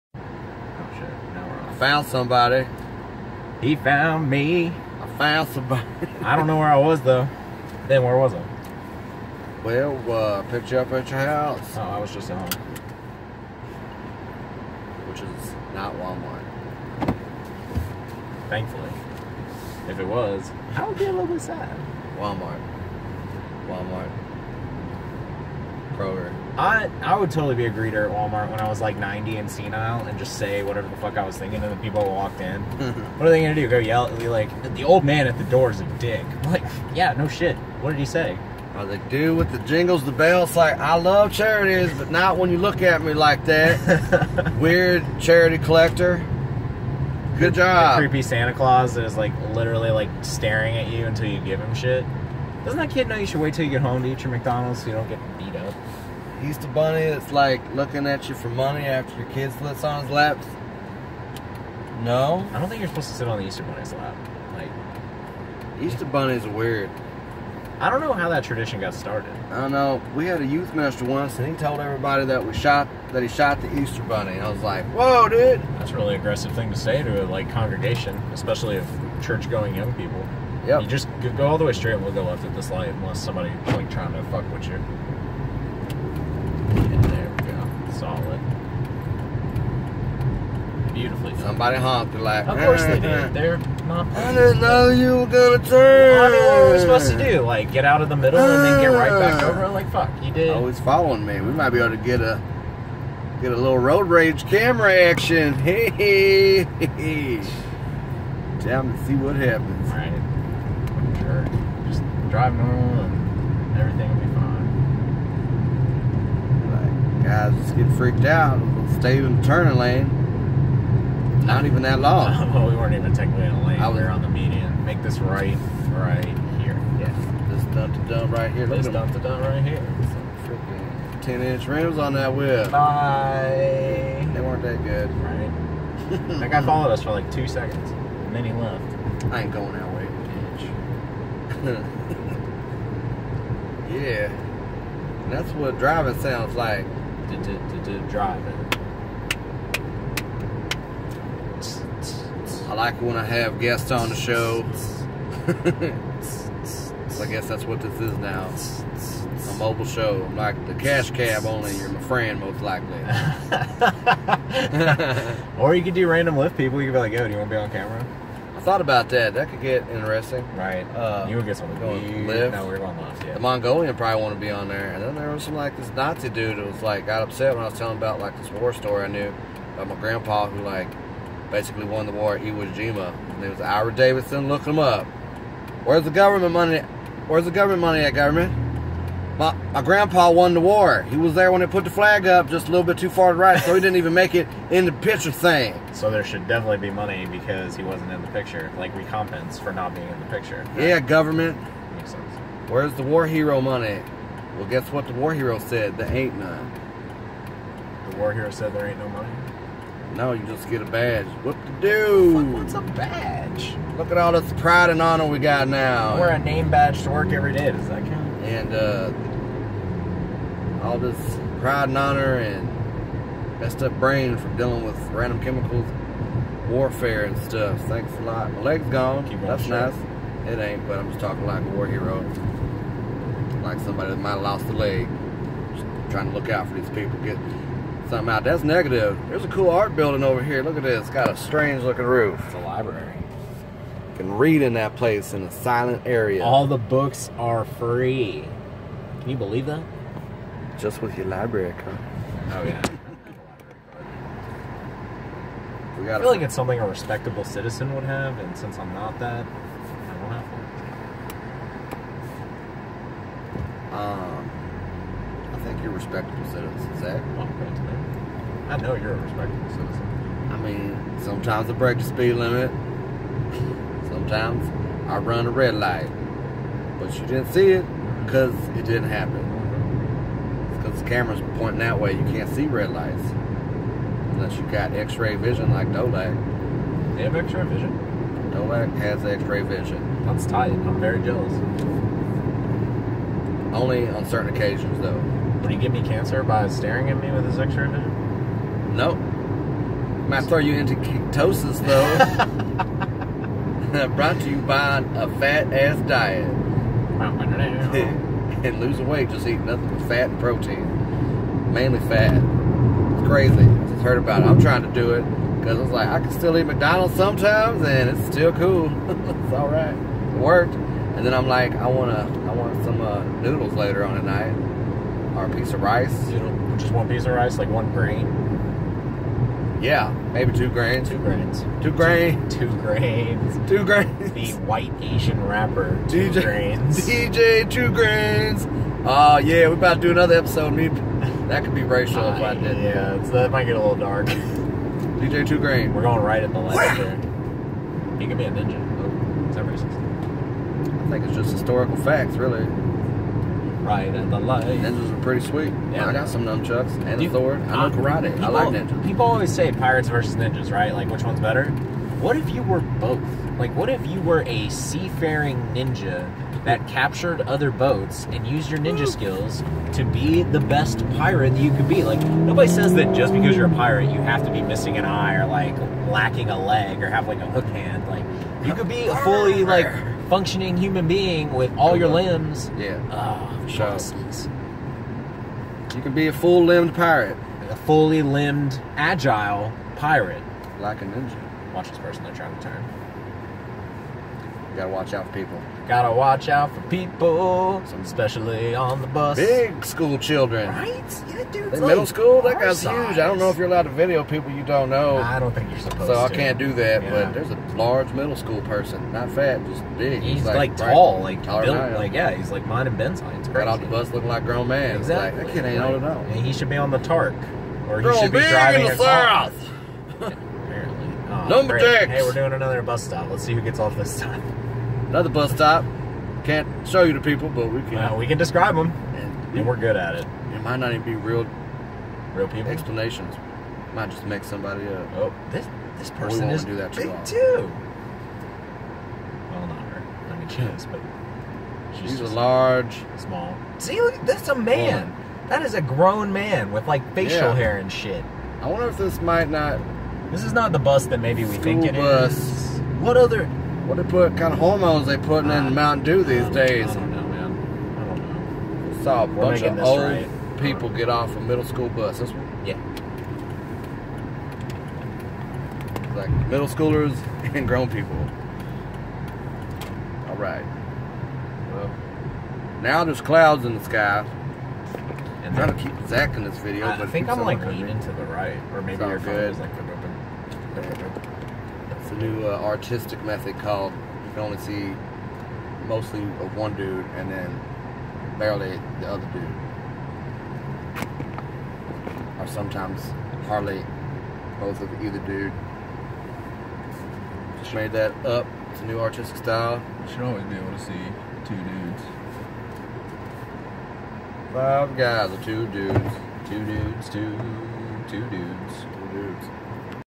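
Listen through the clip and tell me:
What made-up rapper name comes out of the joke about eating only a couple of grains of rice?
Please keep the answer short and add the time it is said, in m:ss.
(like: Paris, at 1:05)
DJ Two Grains, at 5:37.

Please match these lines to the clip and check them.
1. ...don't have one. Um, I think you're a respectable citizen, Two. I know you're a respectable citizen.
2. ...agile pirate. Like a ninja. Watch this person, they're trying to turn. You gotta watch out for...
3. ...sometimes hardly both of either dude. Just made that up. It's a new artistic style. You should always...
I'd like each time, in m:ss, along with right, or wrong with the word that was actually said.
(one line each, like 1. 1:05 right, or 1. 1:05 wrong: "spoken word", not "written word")
1. 4:19 wrong: "Zach", not "Two"
2. 6:28 right
3. 8:12 right.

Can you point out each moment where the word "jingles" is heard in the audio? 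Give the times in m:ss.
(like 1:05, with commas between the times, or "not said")
0:39.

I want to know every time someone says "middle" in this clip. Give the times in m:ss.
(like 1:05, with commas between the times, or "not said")
1:38, 6:41, 6:48, 7:41, 7:46.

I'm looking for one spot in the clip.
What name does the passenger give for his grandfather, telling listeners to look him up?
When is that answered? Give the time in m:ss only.
3:03.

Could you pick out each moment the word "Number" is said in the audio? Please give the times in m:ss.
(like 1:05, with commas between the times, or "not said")
7:01.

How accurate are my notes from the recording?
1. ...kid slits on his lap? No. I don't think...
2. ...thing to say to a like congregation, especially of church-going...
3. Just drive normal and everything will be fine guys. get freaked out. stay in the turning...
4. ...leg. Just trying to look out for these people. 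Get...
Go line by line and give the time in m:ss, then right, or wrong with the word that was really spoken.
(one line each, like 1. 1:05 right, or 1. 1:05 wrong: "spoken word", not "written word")
1. 0:59 right
2. 1:16 right
3. 1:51 right
4. 3:54 right.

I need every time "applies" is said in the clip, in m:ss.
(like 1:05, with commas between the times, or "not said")
not said.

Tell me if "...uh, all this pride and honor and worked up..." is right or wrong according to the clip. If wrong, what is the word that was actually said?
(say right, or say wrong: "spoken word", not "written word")
wrong: "messed", not "worked".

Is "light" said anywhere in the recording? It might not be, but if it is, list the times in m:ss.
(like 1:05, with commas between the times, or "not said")
1:22, 4:35, 4:42, 5:54.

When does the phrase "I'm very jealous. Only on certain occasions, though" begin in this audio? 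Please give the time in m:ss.
4:50.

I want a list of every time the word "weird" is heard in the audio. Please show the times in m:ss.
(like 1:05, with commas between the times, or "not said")
0:44, 1:06.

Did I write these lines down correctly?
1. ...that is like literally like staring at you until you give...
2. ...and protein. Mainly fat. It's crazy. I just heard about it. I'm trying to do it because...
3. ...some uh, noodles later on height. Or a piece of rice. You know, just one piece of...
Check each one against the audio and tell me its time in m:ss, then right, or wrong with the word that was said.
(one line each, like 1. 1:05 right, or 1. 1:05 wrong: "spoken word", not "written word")
1. 0:48 right
2. 5:10 right
3. 5:22 wrong: "tonight", not "height".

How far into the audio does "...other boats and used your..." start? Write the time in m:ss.
6:07.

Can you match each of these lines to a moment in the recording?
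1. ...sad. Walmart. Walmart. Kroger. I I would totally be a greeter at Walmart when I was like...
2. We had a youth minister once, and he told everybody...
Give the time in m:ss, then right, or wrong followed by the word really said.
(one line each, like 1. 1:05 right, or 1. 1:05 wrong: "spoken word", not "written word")
1. 0:21 right
2. 1:10 right.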